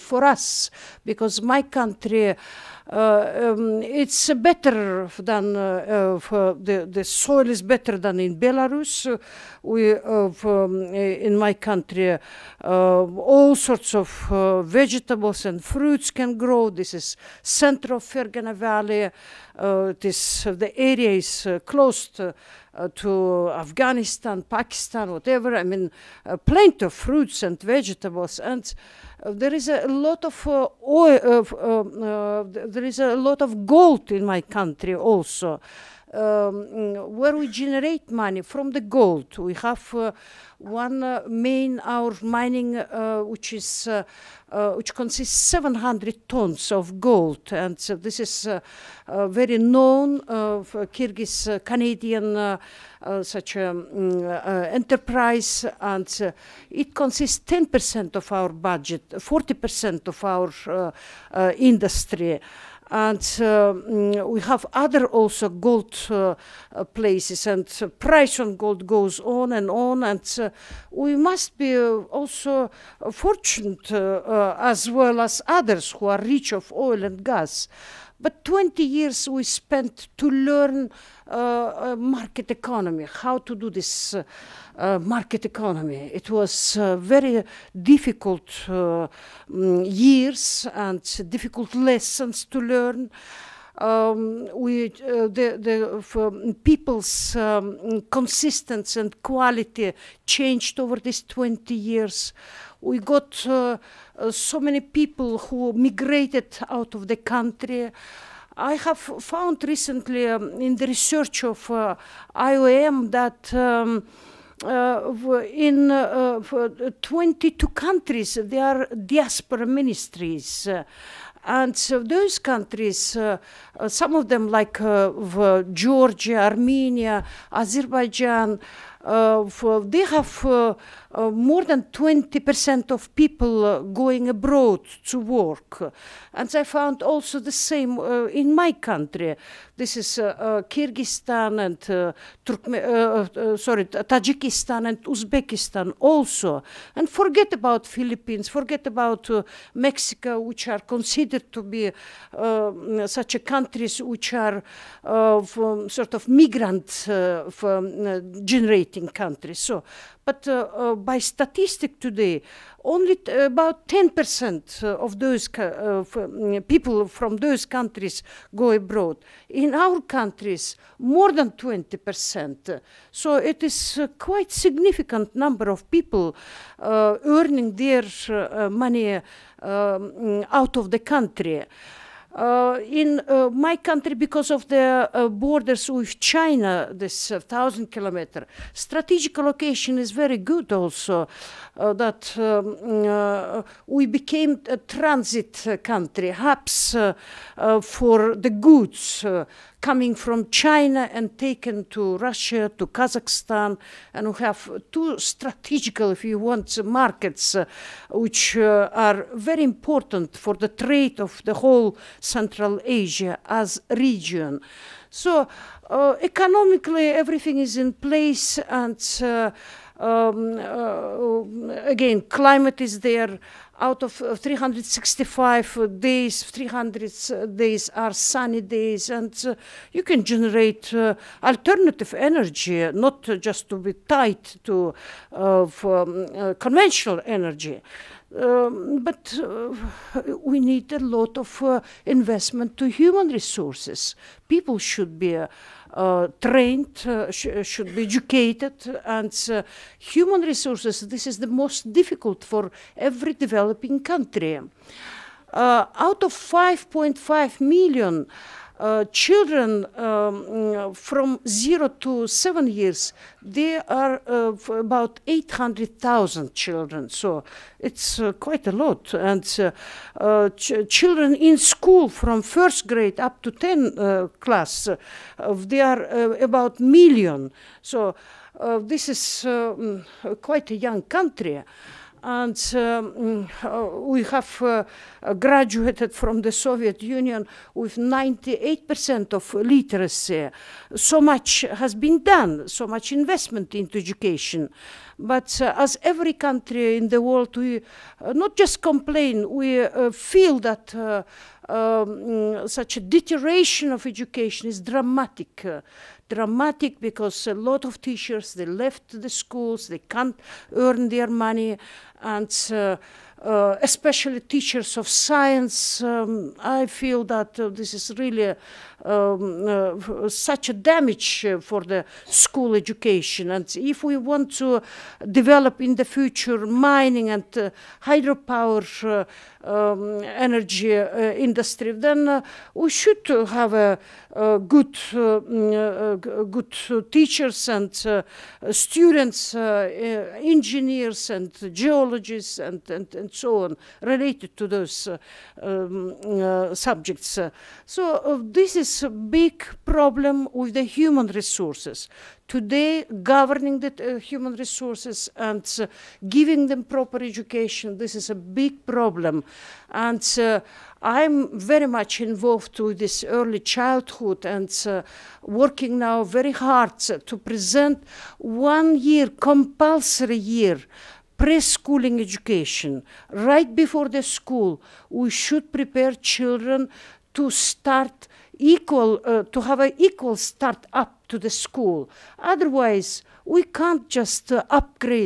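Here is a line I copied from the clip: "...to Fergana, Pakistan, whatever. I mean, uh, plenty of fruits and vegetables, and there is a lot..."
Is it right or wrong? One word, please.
wrong.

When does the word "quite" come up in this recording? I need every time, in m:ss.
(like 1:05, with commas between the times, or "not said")
2:54, 4:28, 4:40.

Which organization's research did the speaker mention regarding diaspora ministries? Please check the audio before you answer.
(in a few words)
IOM.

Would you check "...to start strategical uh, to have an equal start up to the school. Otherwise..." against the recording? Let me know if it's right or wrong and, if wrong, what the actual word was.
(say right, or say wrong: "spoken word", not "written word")
wrong: "equal", not "strategical".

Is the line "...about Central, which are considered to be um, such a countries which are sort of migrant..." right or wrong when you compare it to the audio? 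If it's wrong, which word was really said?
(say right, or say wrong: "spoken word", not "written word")
wrong: "Mexico", not "Central".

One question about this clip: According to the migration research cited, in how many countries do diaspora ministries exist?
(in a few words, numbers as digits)
22.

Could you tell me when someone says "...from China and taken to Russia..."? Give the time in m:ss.
3:20.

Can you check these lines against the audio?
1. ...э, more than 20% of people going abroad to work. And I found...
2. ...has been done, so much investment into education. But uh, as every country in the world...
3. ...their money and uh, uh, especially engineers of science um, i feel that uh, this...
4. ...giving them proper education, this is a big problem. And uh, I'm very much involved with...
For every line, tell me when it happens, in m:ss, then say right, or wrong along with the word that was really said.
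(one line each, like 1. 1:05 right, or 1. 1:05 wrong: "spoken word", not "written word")
1. 2:11 right
2. 4:51 right
3. 5:11 wrong: "teachers", not "engineers"
4. 5:56 right.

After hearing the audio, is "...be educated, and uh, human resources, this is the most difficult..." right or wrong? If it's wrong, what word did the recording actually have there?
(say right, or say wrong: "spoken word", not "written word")
right.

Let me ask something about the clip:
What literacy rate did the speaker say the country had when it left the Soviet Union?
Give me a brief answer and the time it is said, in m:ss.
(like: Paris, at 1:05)
98%, at 4:47.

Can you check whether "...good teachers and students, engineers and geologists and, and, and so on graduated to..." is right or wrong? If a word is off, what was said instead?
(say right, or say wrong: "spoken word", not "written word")
wrong: "related", not "graduated".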